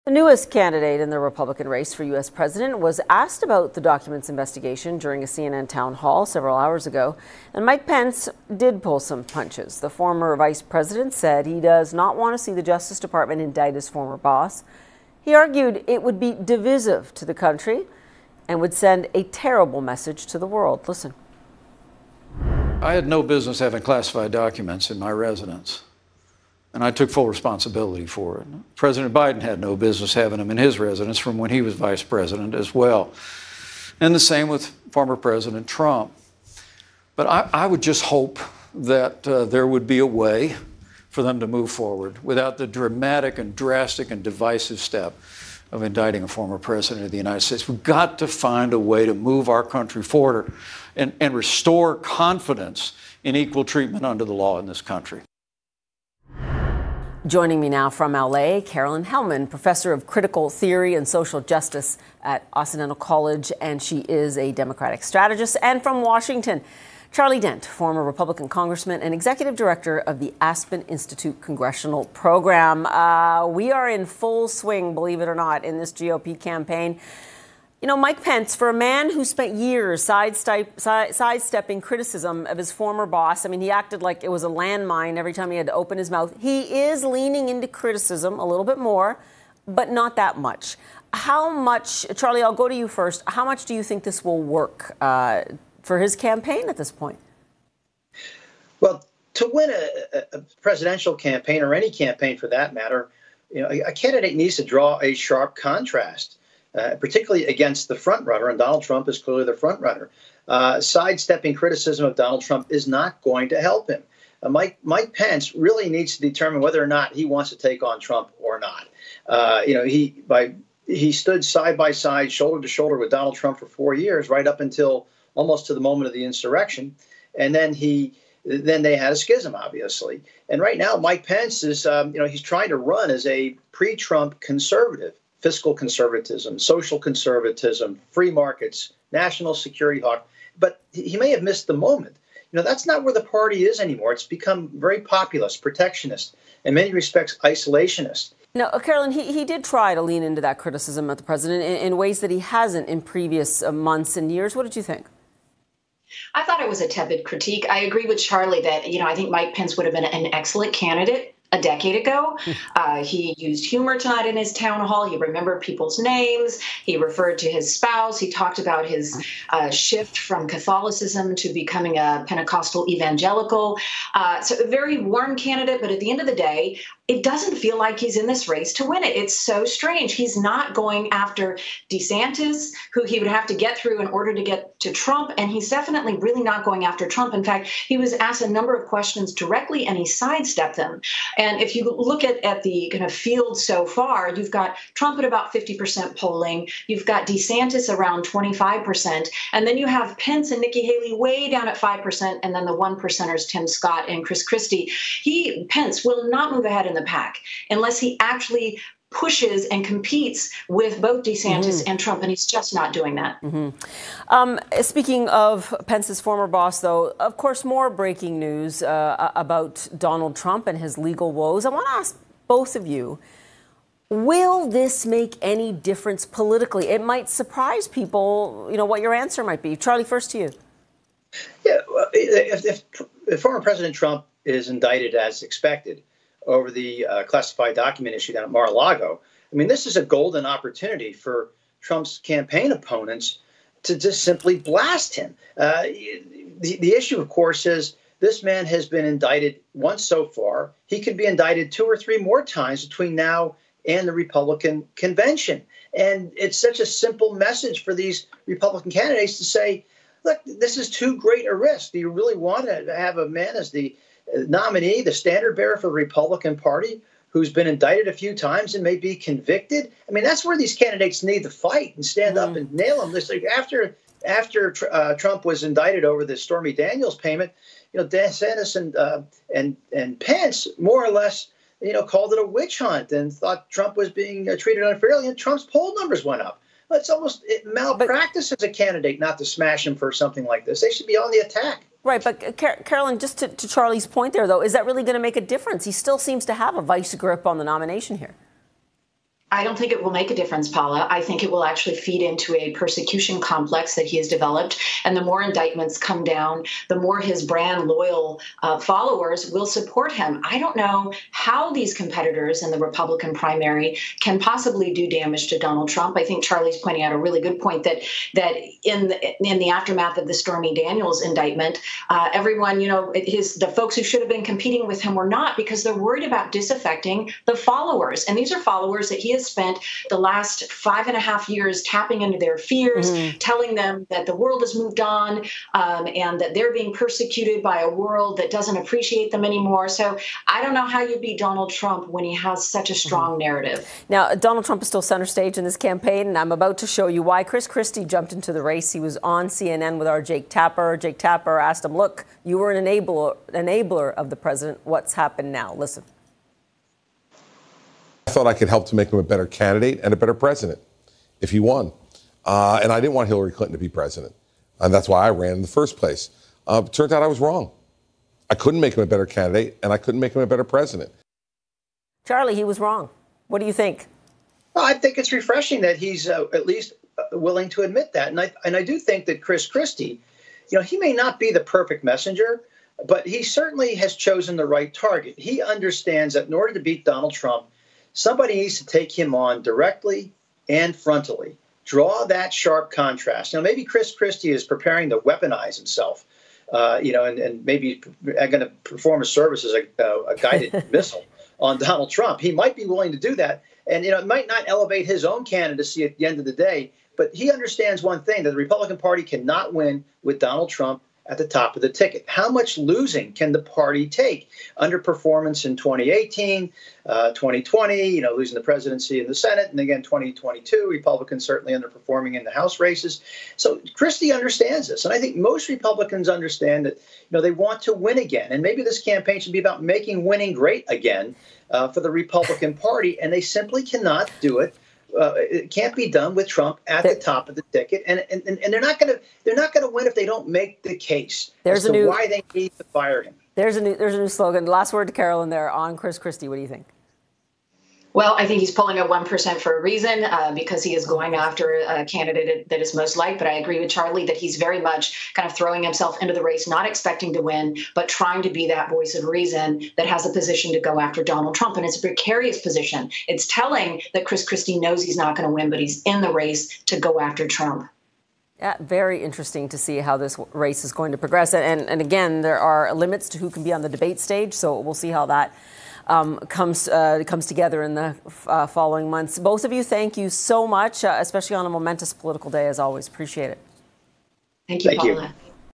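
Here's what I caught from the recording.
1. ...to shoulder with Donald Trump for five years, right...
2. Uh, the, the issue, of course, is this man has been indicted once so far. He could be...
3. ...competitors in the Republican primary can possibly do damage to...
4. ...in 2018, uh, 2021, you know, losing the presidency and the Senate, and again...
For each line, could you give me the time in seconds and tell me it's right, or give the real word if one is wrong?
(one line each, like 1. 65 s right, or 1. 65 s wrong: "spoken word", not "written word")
1. 122 s wrong: "four", not "five"
2. 245 s right
3. 311 s right
4. 415 s wrong: "2020", not "2021".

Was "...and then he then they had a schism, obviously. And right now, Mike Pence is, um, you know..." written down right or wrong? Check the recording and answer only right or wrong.
right.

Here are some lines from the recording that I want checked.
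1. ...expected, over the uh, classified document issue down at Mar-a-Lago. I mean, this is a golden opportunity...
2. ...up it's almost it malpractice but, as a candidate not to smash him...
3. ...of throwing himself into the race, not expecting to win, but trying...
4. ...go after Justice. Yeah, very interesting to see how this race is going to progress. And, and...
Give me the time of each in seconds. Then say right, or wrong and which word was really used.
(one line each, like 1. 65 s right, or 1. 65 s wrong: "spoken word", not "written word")
1. 235 s right
2. 286 s right
3. 455 s right
4. 466 s wrong: "Trump", not "Justice".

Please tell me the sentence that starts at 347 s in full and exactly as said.
Chris Christie jumped into the race.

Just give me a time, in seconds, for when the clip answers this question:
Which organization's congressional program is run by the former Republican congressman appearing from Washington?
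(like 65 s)
70 s.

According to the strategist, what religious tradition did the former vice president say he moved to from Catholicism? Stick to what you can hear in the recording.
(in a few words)
Pentecostal evangelical.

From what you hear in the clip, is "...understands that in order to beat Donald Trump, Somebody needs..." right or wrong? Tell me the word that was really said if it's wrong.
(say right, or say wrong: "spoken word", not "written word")
right.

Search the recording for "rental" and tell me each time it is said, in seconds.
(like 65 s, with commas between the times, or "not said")
not said.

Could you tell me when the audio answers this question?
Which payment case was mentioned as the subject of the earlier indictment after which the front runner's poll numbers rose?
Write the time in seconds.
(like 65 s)
276 s.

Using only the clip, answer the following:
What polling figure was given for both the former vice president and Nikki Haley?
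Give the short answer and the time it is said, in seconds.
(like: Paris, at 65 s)
5%, at 201 s.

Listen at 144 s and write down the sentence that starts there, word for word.
It's become very populist, protectionist, in many respects, isolationist.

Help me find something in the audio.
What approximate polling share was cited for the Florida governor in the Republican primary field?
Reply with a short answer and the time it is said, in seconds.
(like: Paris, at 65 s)
25%, at 198 s.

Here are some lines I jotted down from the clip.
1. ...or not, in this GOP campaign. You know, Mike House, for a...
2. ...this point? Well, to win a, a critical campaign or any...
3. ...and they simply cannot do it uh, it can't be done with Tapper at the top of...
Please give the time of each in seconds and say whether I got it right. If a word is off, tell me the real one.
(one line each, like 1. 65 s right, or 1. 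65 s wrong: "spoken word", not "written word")
1. 75 s wrong: "Pence", not "House"
2. 96 s wrong: "presidential", not "critical"
3. 433 s wrong: "Trump", not "Tapper".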